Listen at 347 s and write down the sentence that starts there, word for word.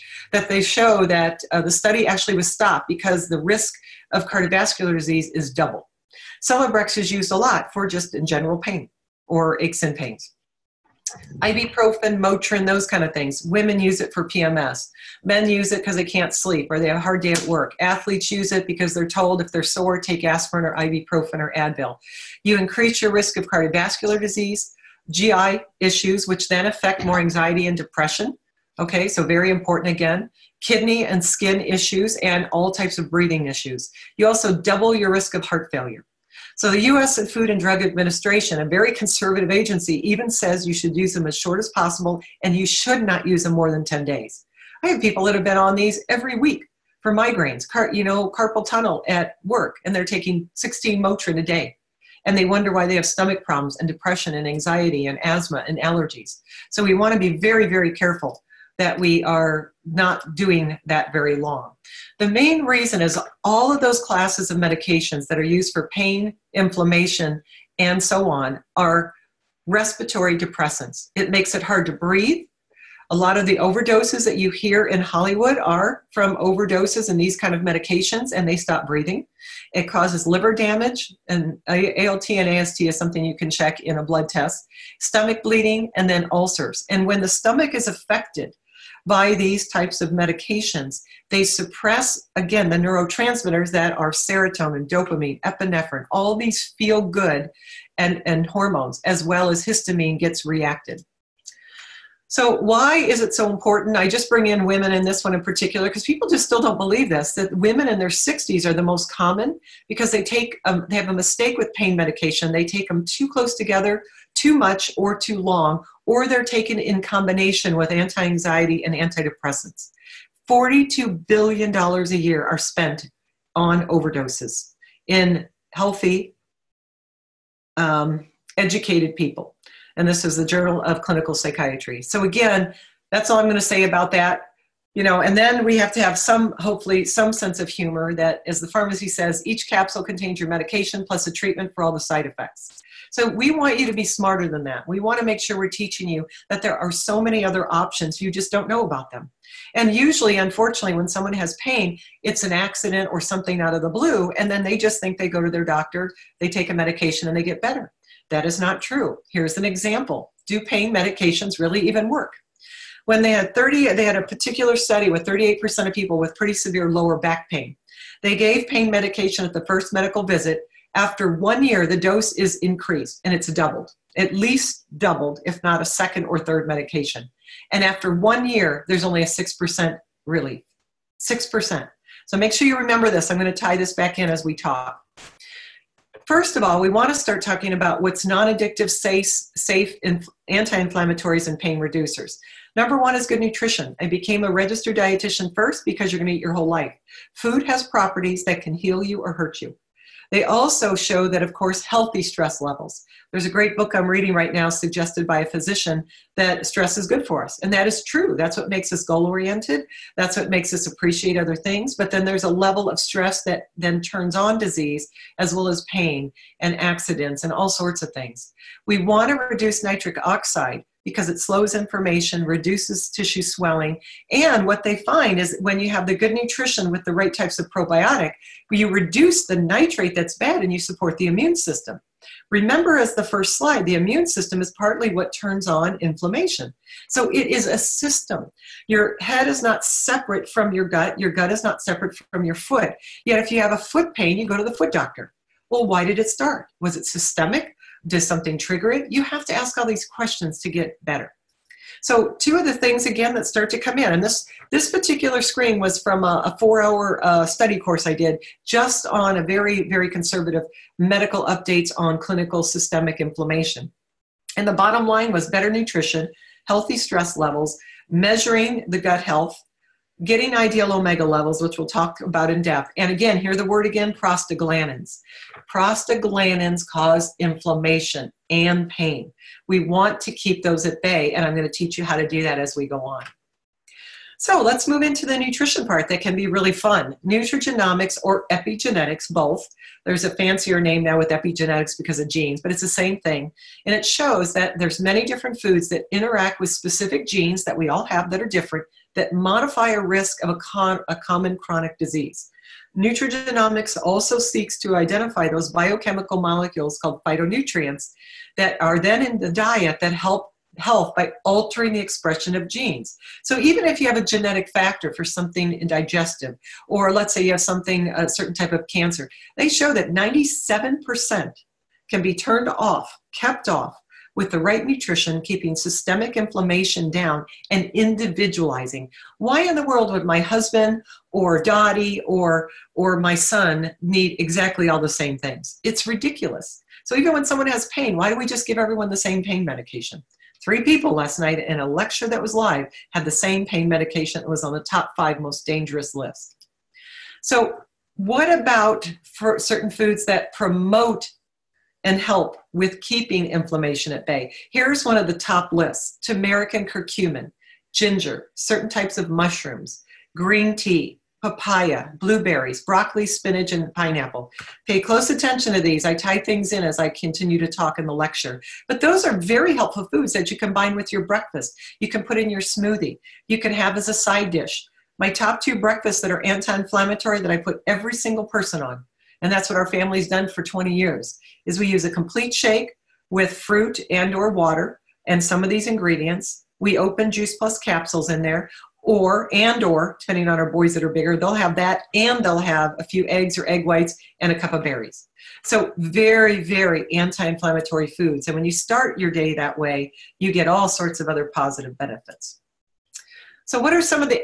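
So, what about for certain foods that promote and help with keeping inflammation at bay.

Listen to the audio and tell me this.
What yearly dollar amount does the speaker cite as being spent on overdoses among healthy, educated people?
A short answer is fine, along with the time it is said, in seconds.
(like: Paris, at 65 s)
$42 billion, at 120 s.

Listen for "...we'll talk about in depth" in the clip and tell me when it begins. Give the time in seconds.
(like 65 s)
271 s.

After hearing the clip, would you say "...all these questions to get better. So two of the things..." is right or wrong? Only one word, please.
right.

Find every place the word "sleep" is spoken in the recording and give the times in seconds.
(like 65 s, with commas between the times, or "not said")
16 s.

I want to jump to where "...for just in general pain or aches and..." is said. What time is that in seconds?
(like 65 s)
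7 s.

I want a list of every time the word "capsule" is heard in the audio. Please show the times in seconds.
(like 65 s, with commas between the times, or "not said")
139 s, 387 s.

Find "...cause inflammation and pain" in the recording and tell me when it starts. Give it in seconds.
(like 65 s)
276 s.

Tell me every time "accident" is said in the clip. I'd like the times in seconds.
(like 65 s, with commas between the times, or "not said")
152 s, 216 s.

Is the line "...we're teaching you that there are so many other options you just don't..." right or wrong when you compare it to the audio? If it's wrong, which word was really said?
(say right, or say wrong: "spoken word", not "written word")
right.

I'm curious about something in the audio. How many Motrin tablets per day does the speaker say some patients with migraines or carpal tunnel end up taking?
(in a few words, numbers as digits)
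16.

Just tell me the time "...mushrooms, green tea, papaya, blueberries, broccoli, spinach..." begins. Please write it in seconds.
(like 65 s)
359 s.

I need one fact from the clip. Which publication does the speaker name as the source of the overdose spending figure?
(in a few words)
Journal of Clinical Psychiatry.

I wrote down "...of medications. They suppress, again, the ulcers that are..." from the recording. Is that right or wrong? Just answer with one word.
wrong.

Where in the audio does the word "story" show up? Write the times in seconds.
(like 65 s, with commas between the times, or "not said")
not said.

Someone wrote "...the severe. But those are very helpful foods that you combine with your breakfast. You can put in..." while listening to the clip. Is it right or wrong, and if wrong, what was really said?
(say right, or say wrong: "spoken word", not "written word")
wrong: "lecture", not "severe".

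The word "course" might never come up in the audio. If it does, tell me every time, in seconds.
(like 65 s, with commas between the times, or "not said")
201 s, 257 s.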